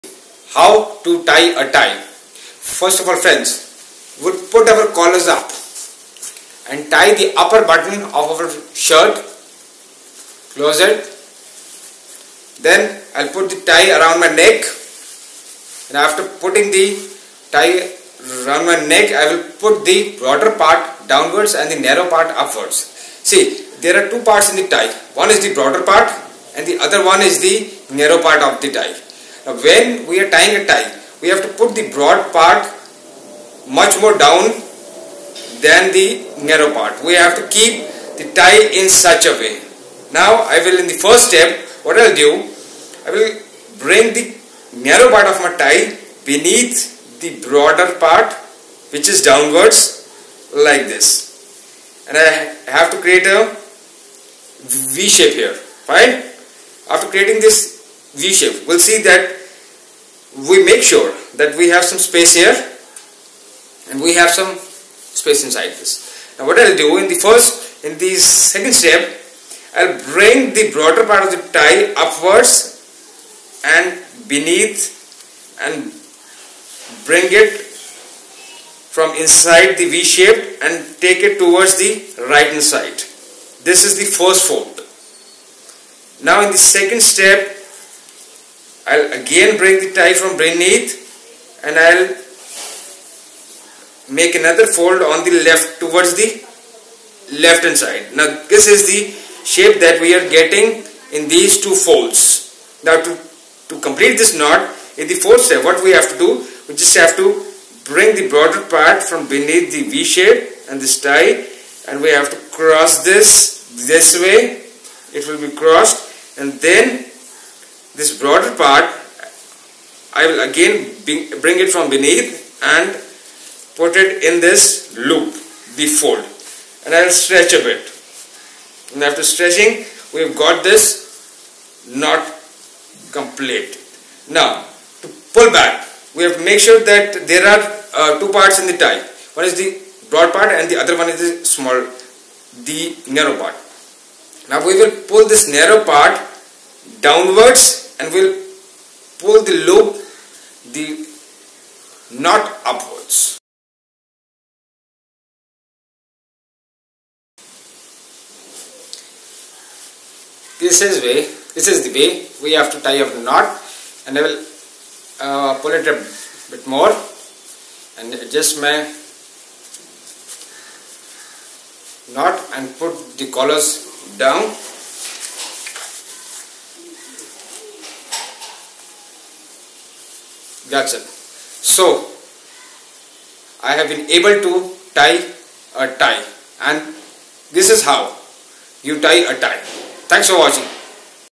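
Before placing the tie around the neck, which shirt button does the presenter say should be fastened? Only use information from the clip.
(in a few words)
The upper button.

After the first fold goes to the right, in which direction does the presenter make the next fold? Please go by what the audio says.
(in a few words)
Left hand side.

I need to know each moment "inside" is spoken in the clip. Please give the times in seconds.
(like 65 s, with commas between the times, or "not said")
65 s, 79 s.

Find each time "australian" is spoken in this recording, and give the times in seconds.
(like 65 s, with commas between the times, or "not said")
not said.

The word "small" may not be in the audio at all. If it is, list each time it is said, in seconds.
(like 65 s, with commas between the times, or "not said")
141 s.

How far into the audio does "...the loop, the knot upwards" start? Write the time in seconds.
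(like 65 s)
149 s.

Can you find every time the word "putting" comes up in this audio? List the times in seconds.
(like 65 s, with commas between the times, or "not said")
16 s.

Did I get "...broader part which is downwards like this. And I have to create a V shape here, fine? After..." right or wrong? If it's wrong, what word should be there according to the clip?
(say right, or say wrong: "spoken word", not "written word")
right.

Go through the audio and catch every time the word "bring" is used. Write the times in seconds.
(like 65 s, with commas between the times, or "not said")
43 s, 70 s, 77 s, 107 s, 121 s.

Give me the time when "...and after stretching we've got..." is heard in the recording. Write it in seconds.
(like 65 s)
128 s.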